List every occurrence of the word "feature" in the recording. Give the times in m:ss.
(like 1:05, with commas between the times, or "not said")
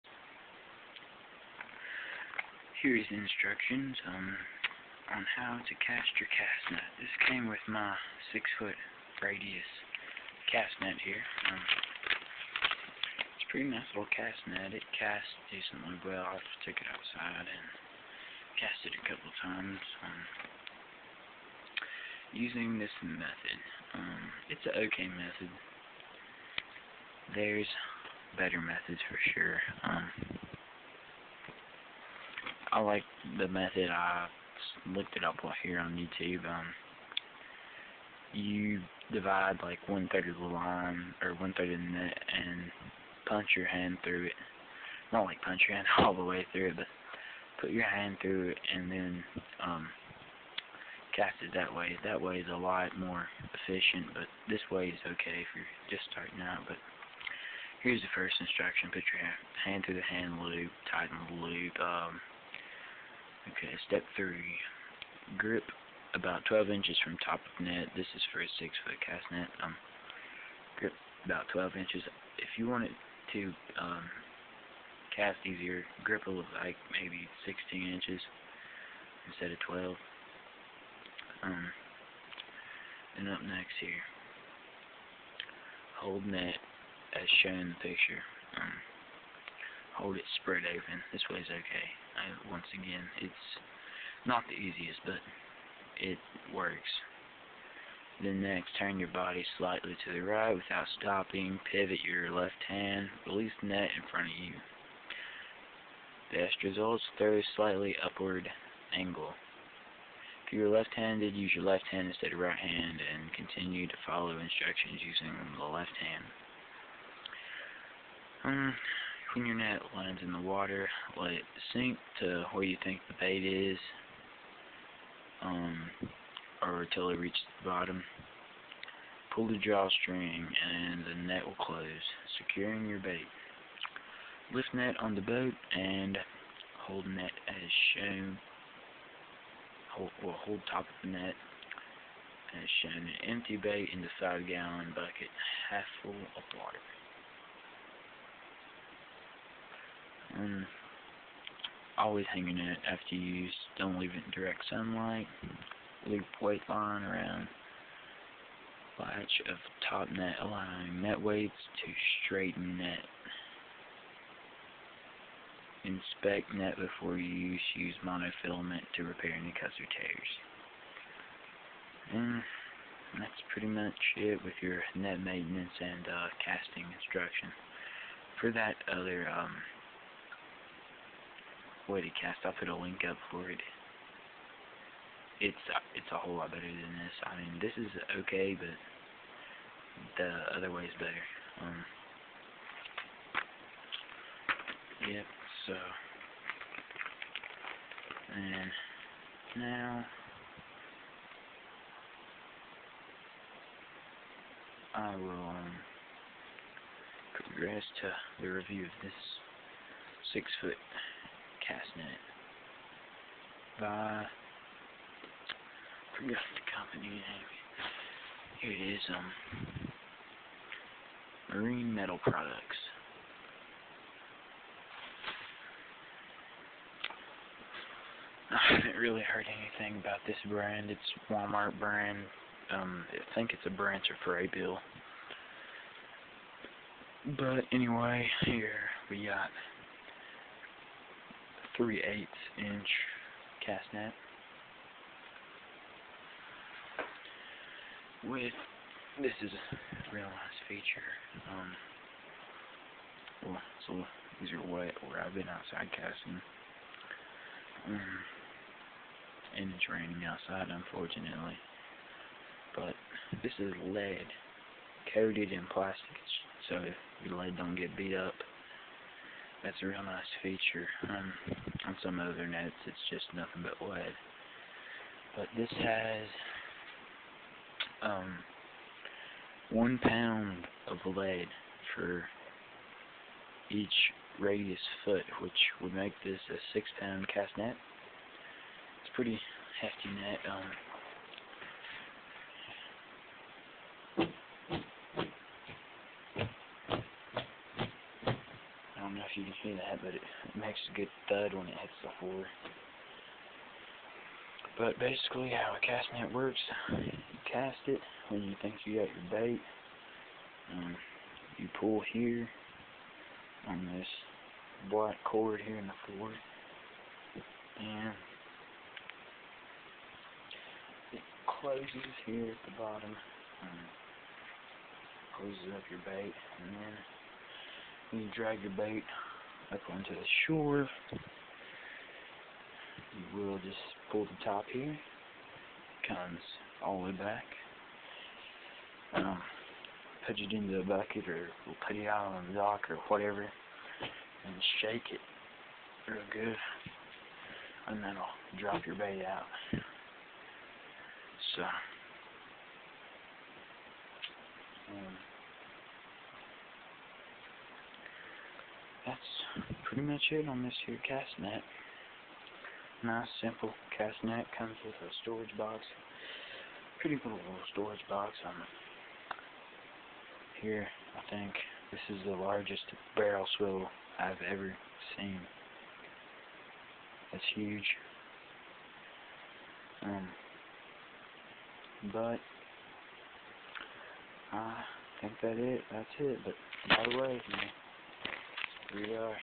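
4:10, 4:30.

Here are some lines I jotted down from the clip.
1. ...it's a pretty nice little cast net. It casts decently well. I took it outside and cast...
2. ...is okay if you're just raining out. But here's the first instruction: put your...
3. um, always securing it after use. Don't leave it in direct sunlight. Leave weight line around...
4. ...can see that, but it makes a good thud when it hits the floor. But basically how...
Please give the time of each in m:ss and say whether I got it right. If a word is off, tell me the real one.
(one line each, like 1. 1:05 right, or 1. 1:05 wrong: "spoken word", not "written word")
1. 0:13 right
2. 0:54 wrong: "starting", not "raining"
3. 2:30 wrong: "hanging", not "securing"
4. 4:59 right.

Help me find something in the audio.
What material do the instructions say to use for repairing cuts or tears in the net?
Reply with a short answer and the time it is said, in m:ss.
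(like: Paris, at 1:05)
monofilament, at 2:48.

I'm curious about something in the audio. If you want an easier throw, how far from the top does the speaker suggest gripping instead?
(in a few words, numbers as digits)
16 inches.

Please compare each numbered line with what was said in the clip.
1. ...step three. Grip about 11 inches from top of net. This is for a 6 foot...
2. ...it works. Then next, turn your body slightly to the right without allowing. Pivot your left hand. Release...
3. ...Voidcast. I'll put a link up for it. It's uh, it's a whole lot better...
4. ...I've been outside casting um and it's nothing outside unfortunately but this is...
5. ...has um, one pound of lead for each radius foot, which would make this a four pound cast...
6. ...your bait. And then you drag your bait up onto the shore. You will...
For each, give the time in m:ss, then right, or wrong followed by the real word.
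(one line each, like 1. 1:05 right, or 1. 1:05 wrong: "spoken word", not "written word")
1. 1:03 wrong: "12", not "11"
2. 1:36 wrong: "stopping", not "allowing"
3. 3:01 right
4. 4:15 wrong: "raining", not "nothing"
5. 4:35 wrong: "six", not "four"
6. 5:25 right.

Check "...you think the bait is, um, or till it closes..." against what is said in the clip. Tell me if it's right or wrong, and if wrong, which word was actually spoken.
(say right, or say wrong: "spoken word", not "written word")
wrong: "reaches", not "closes".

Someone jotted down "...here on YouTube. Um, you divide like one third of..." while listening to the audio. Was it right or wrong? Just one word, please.
right.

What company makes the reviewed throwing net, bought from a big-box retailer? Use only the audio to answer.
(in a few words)
Marine Metal Products.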